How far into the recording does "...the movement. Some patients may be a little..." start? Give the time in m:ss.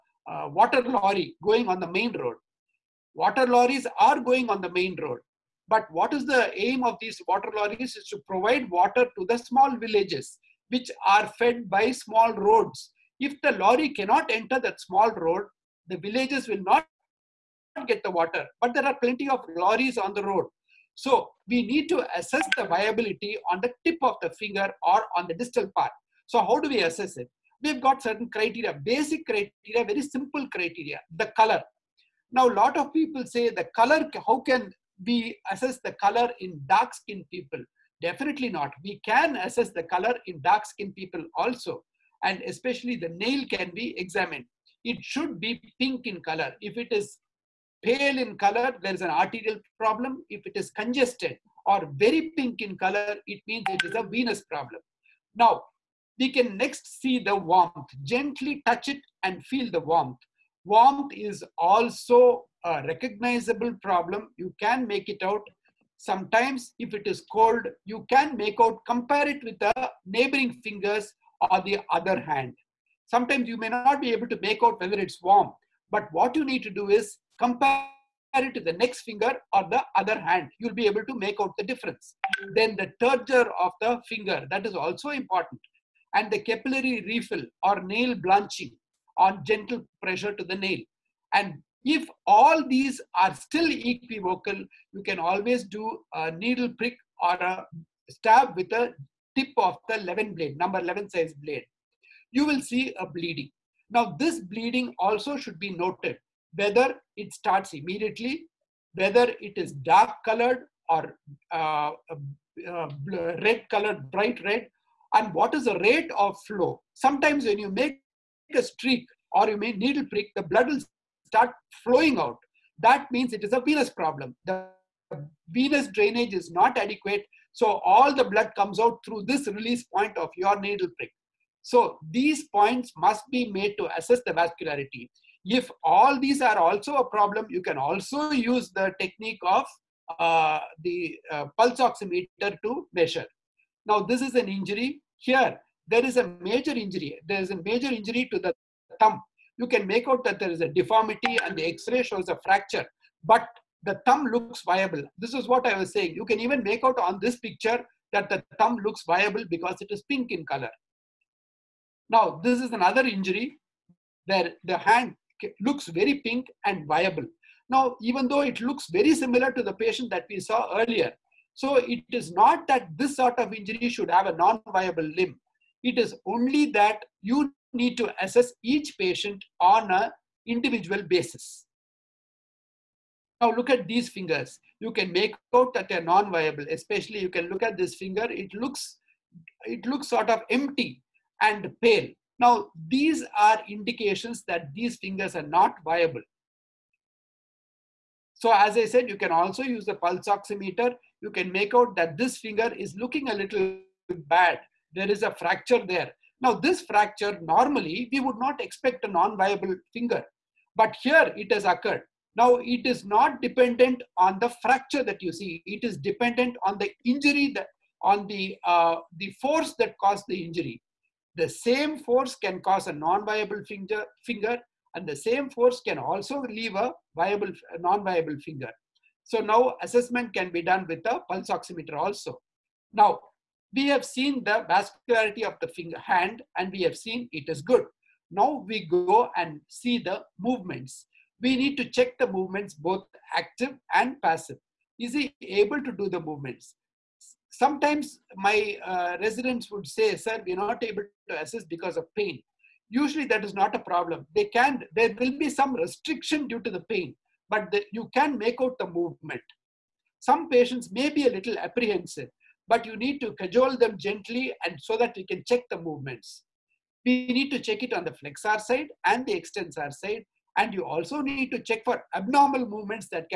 4:18.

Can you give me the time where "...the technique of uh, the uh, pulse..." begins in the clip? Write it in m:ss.
2:18.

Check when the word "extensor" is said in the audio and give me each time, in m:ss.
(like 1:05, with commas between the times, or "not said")
4:29.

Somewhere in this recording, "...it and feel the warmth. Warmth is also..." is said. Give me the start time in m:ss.
0:58.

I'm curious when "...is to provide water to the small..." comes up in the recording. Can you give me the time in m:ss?
0:07.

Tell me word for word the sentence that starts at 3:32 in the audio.
Now it is not dependent on the fracture that you see.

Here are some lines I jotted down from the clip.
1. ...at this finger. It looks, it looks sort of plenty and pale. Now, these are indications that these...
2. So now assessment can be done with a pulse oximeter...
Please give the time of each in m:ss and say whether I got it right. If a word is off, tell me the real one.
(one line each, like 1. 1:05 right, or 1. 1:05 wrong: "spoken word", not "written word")
1. 3:07 wrong: "empty", not "plenty"
2. 3:49 right.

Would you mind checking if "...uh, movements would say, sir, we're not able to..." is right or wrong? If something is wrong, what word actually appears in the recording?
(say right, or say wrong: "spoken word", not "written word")
wrong: "residents", not "movements".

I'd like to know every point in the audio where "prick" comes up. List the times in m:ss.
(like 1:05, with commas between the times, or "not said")
1:36, 2:00, 2:10.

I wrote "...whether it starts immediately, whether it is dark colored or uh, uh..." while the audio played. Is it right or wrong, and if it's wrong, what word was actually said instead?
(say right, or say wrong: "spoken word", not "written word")
right.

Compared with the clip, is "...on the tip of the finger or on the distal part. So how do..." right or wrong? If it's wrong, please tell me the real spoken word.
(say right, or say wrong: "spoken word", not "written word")
right.